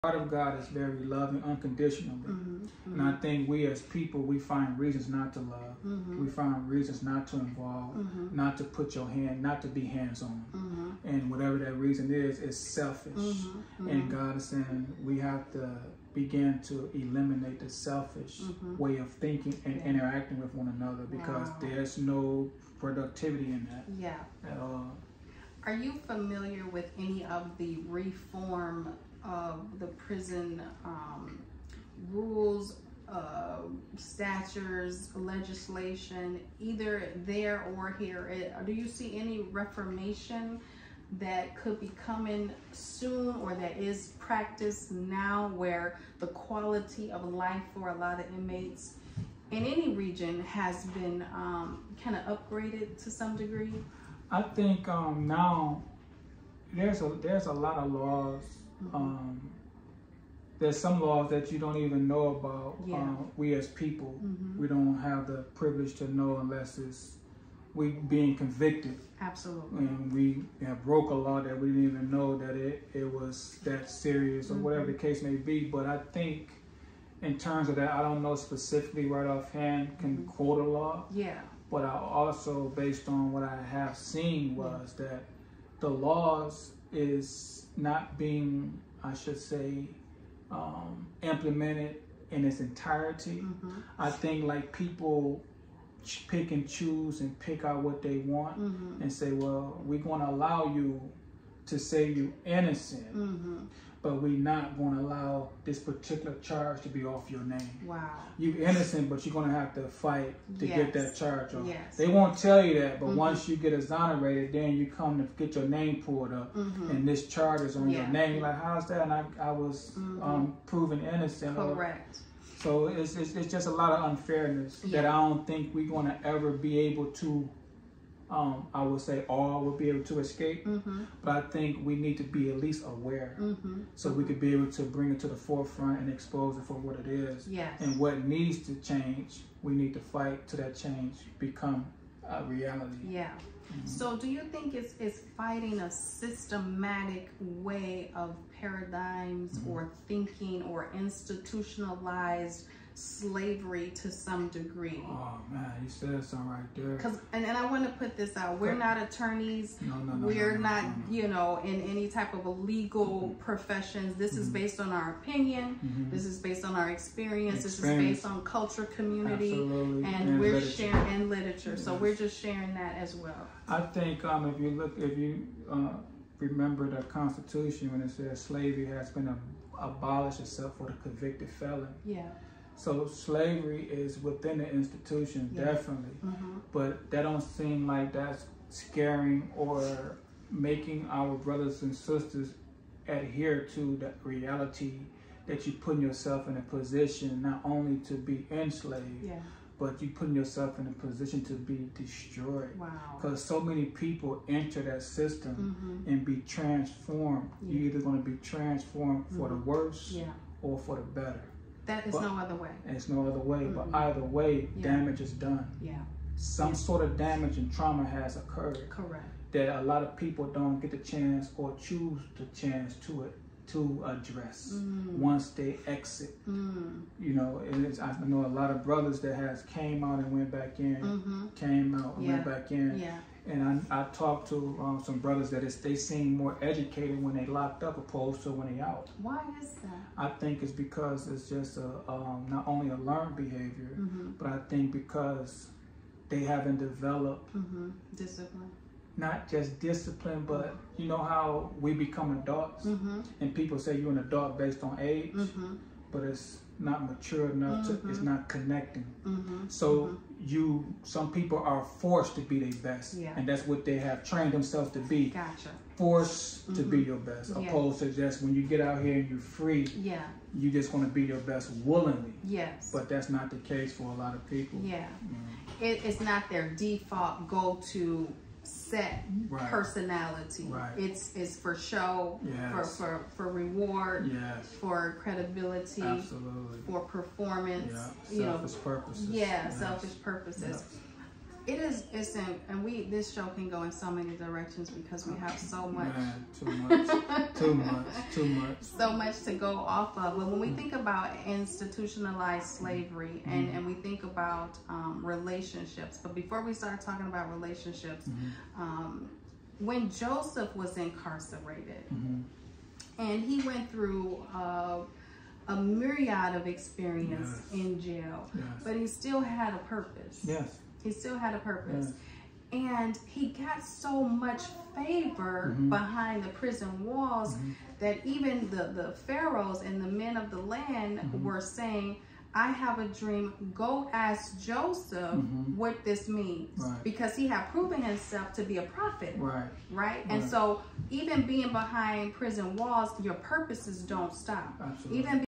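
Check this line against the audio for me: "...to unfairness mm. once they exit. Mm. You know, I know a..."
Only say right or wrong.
wrong.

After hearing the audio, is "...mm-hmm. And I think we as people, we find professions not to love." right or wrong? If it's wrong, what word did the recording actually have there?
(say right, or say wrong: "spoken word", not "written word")
wrong: "reasons", not "professions".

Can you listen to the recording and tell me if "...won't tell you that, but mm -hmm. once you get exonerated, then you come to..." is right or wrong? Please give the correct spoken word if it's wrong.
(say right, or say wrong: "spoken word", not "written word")
right.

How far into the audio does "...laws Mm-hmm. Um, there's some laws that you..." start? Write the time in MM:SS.
00:57.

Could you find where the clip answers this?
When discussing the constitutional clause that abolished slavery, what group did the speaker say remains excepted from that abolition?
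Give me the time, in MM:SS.
03:00.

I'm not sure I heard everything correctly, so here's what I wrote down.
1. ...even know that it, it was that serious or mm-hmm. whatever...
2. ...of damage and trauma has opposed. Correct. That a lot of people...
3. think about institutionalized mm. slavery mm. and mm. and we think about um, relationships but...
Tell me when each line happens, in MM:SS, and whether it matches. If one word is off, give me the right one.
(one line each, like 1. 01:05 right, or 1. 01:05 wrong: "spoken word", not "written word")
1. 01:11 right
2. 03:37 wrong: "occurred", not "opposed"
3. 05:00 right.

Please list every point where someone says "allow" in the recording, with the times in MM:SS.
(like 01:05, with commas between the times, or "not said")
01:40, 01:45.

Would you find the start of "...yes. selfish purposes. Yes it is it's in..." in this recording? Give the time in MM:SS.
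04:49.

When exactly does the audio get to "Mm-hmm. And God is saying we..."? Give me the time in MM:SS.
00:13.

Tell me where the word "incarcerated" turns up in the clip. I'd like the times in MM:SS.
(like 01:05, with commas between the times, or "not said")
05:10.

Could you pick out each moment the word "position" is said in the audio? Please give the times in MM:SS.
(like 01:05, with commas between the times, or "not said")
03:16, 03:21.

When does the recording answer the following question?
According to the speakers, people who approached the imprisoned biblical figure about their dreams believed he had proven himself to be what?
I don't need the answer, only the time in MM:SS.
05:38.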